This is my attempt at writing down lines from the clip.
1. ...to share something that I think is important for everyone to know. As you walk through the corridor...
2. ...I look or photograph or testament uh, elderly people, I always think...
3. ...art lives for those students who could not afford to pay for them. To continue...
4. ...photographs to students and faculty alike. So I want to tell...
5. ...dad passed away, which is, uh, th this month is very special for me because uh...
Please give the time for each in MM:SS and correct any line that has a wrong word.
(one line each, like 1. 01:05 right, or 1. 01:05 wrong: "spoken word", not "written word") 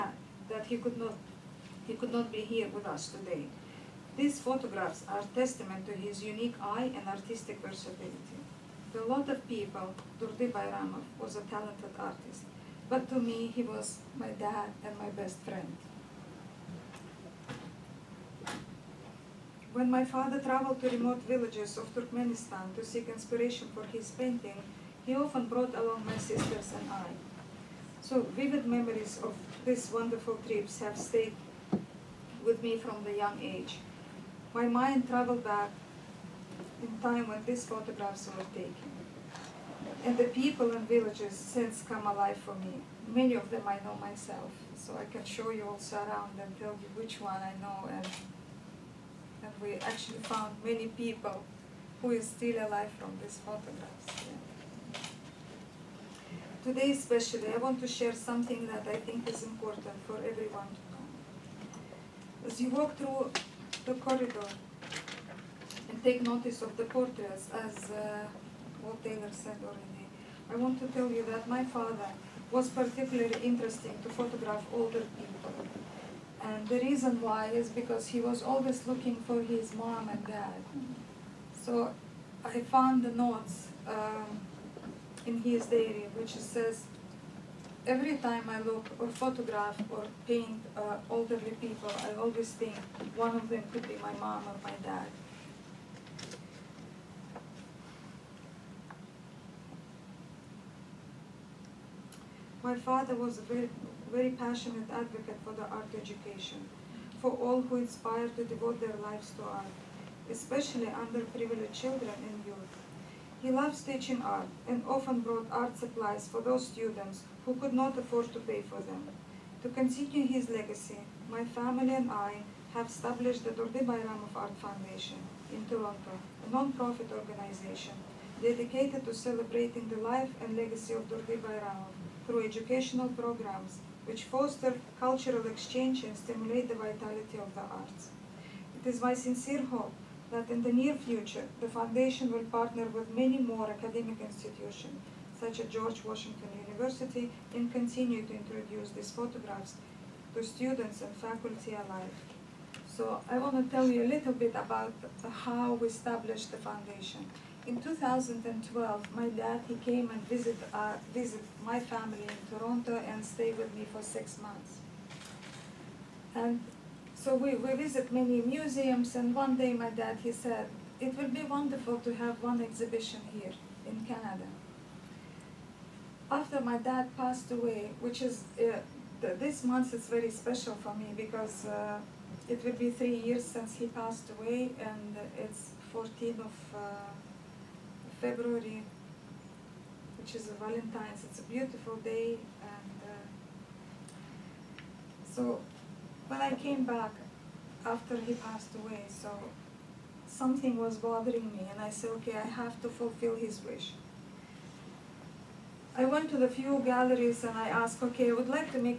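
1. 00:57 right
2. 01:28 wrong: "paint", not "testament"
3. 01:55 wrong: "supplies", not "lives"
4. 02:29 right
5. 02:56 right.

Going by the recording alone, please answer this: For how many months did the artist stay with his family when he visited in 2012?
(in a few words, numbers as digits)
6.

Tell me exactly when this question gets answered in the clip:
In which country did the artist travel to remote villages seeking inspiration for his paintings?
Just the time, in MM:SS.
00:21.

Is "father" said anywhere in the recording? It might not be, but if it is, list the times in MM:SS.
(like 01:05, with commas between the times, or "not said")
00:20, 01:11, 01:42.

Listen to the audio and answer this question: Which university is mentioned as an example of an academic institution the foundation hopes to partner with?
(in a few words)
George Washington University.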